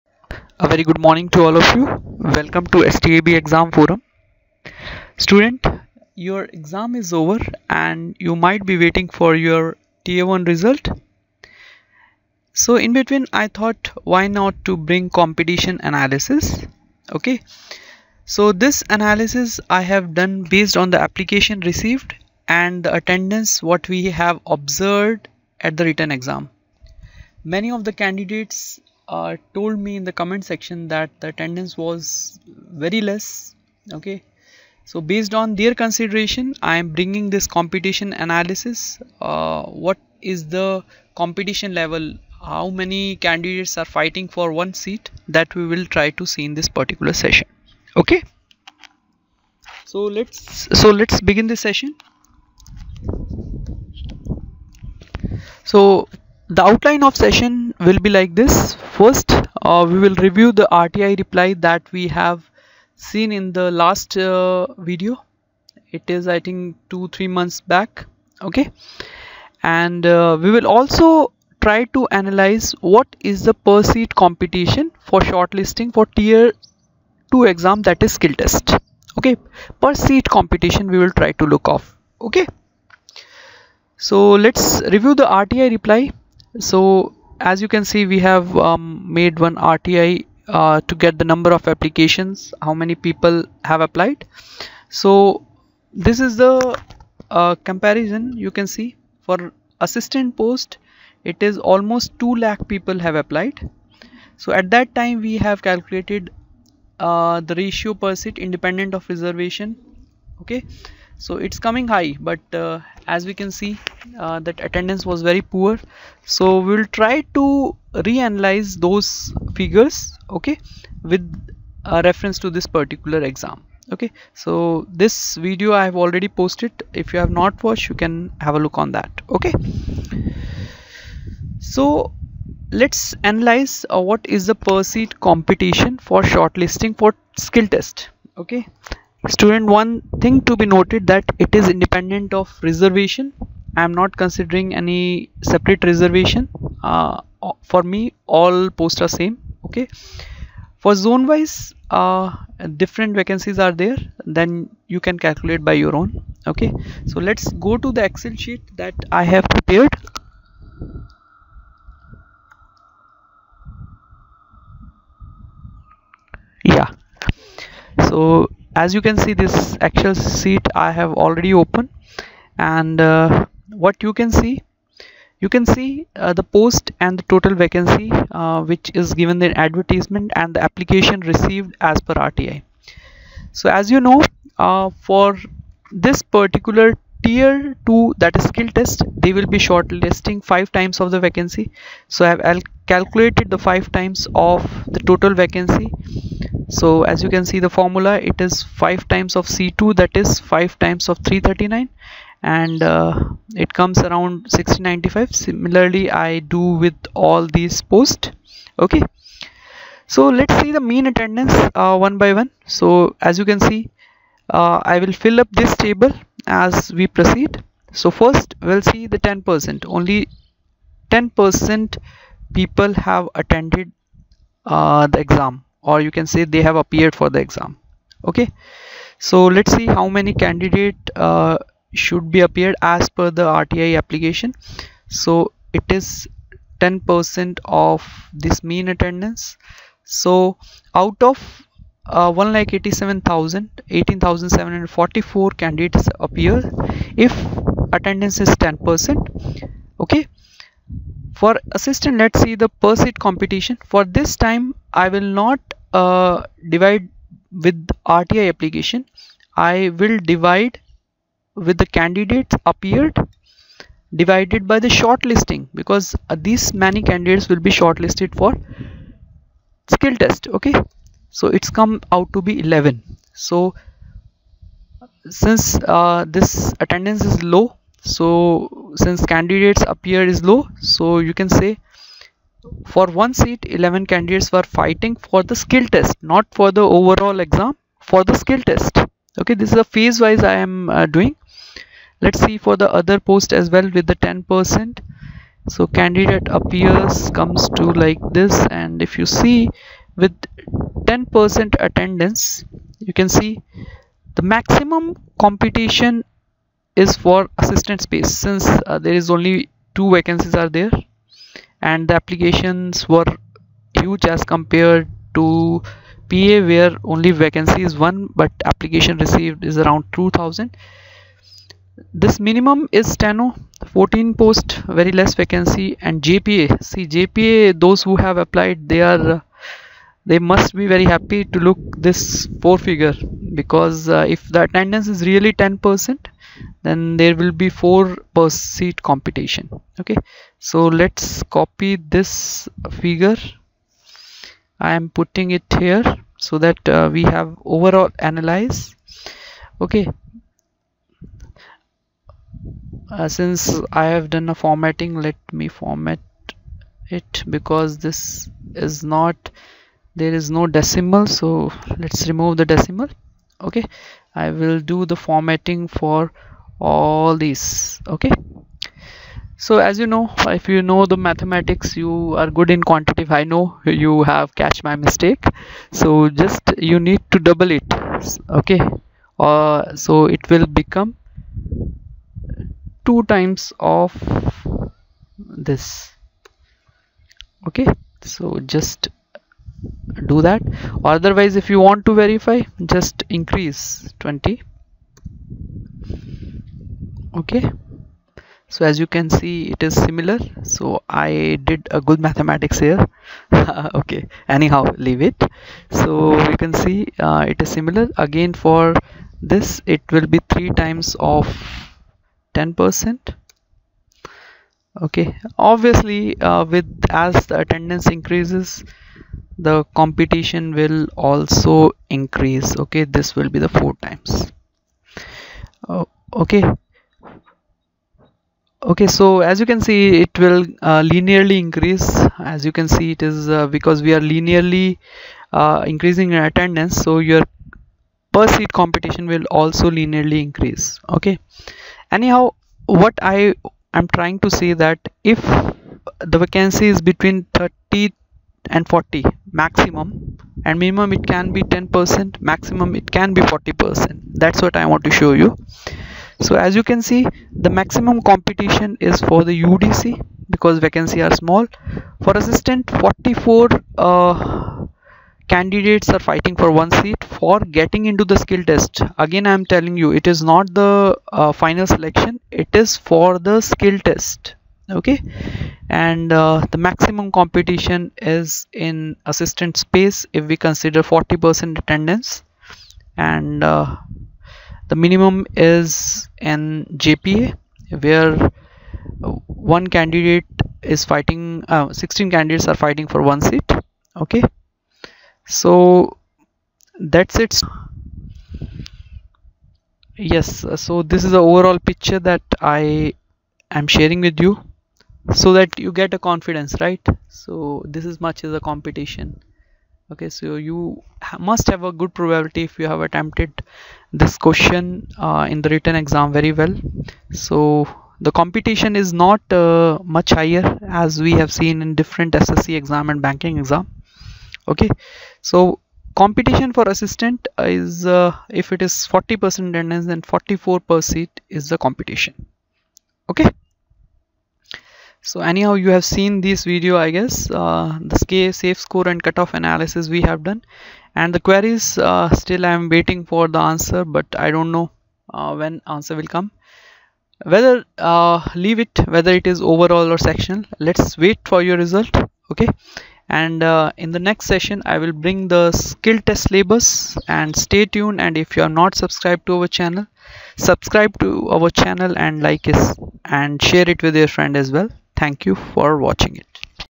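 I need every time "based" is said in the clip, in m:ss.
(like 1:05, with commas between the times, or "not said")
0:20, 0:35.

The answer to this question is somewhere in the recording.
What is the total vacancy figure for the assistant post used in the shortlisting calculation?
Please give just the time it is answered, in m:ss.
3:21.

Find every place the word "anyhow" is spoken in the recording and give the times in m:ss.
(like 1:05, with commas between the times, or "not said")
6:44, 7:22, 8:55.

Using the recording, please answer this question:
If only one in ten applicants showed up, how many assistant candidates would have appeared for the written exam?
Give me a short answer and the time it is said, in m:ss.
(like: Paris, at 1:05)
18,744, at 4:03.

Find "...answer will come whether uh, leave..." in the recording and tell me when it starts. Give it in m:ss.
9:05.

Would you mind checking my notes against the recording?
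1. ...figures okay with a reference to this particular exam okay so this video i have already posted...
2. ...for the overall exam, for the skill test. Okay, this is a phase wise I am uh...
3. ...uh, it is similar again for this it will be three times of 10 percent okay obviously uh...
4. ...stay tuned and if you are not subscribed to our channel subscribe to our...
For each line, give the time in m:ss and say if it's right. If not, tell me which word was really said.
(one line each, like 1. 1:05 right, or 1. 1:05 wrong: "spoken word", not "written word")
1. 1:59 right
2. 4:46 right
3. 6:47 right
4. 9:17 right.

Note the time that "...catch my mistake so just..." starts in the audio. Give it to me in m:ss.
6:14.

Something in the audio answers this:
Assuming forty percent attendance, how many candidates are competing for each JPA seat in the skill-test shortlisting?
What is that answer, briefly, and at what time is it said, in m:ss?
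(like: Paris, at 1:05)
16, at 8:11.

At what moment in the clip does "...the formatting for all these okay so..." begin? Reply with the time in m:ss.
6:05.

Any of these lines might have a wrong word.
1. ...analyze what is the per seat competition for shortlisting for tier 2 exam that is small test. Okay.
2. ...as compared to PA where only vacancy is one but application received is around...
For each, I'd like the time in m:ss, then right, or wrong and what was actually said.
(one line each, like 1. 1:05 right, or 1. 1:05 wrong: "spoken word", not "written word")
1. 1:12 wrong: "skill", not "small"
2. 5:14 right.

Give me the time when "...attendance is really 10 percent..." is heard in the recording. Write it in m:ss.
5:34.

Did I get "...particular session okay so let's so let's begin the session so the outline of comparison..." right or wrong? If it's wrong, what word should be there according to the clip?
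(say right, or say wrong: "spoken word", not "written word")
wrong: "session", not "comparison".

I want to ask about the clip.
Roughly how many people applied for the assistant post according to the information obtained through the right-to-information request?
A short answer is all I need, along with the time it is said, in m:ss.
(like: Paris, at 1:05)
2 lakh, at 1:42.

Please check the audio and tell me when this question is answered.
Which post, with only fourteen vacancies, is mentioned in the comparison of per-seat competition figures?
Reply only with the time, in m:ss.
5:23.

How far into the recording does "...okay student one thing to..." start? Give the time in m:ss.
2:18.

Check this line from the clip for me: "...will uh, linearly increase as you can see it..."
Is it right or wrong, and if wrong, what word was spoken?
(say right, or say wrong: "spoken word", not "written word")
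right.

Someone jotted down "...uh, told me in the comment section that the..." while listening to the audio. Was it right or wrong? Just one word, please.
right.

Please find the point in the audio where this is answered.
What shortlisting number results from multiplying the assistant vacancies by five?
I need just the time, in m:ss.
3:24.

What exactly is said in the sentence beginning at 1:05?
It is, I think, two, three months back.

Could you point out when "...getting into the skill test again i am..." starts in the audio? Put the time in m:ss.
7:47.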